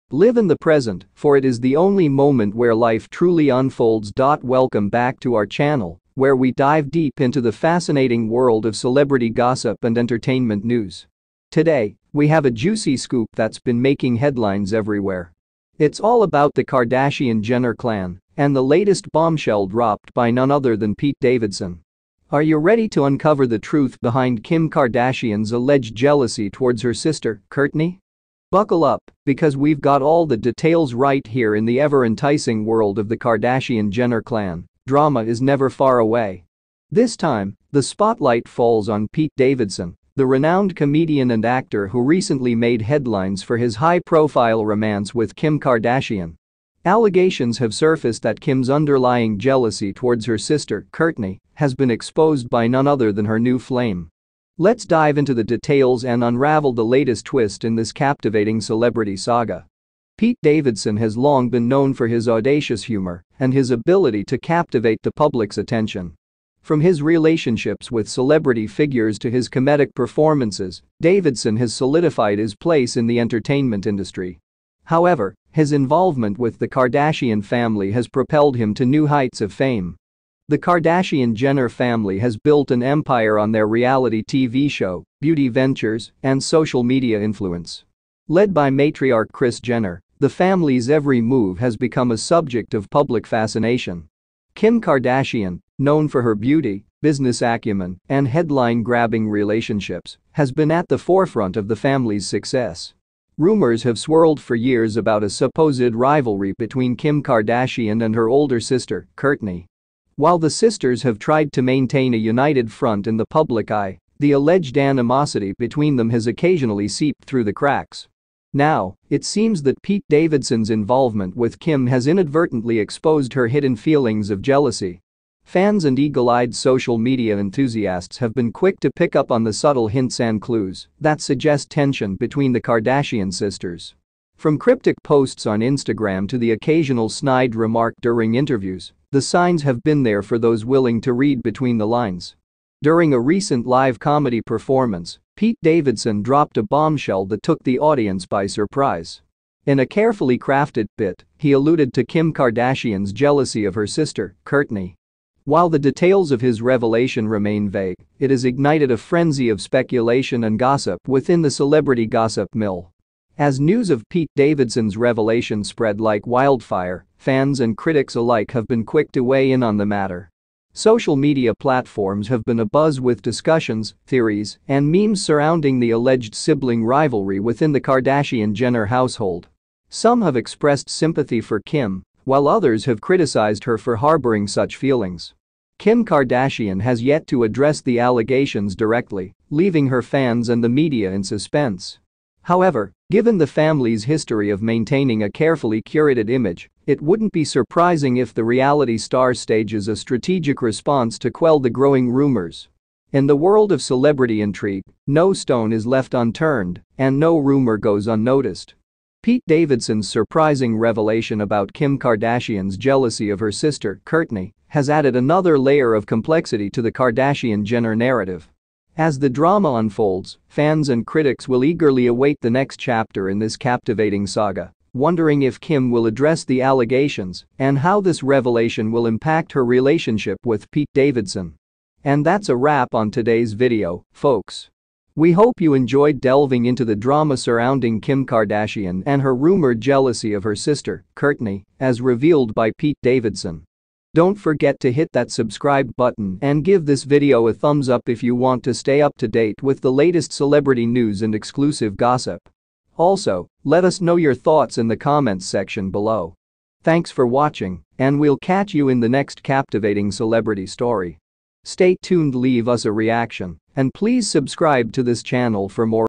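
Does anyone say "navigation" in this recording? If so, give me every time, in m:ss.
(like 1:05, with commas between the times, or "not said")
not said.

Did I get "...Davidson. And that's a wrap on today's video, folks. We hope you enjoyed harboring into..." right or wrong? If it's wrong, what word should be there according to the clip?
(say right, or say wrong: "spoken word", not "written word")
wrong: "delving", not "harboring".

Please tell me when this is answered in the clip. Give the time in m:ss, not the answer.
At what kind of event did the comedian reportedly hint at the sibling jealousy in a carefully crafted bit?
2:23.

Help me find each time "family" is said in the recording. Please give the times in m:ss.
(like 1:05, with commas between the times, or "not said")
1:17, 1:21, 1:30, 1:41, 3:13.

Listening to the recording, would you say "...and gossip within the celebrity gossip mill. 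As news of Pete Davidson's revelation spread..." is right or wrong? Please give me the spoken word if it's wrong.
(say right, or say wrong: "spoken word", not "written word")
right.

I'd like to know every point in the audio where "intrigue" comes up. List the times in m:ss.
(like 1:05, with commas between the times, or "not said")
3:24.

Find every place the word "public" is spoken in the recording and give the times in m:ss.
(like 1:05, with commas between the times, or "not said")
1:05, 1:32, 1:53.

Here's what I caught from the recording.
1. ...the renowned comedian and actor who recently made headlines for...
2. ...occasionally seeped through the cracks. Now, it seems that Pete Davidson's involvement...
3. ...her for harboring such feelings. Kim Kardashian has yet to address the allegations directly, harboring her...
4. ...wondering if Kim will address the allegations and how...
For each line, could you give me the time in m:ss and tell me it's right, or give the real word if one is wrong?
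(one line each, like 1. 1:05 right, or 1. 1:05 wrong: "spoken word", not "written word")
1. 0:40 right
2. 1:56 right
3. 3:03 wrong: "leaving", not "harboring"
4. 3:44 right.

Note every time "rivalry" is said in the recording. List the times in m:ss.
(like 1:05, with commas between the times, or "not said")
1:45, 2:56.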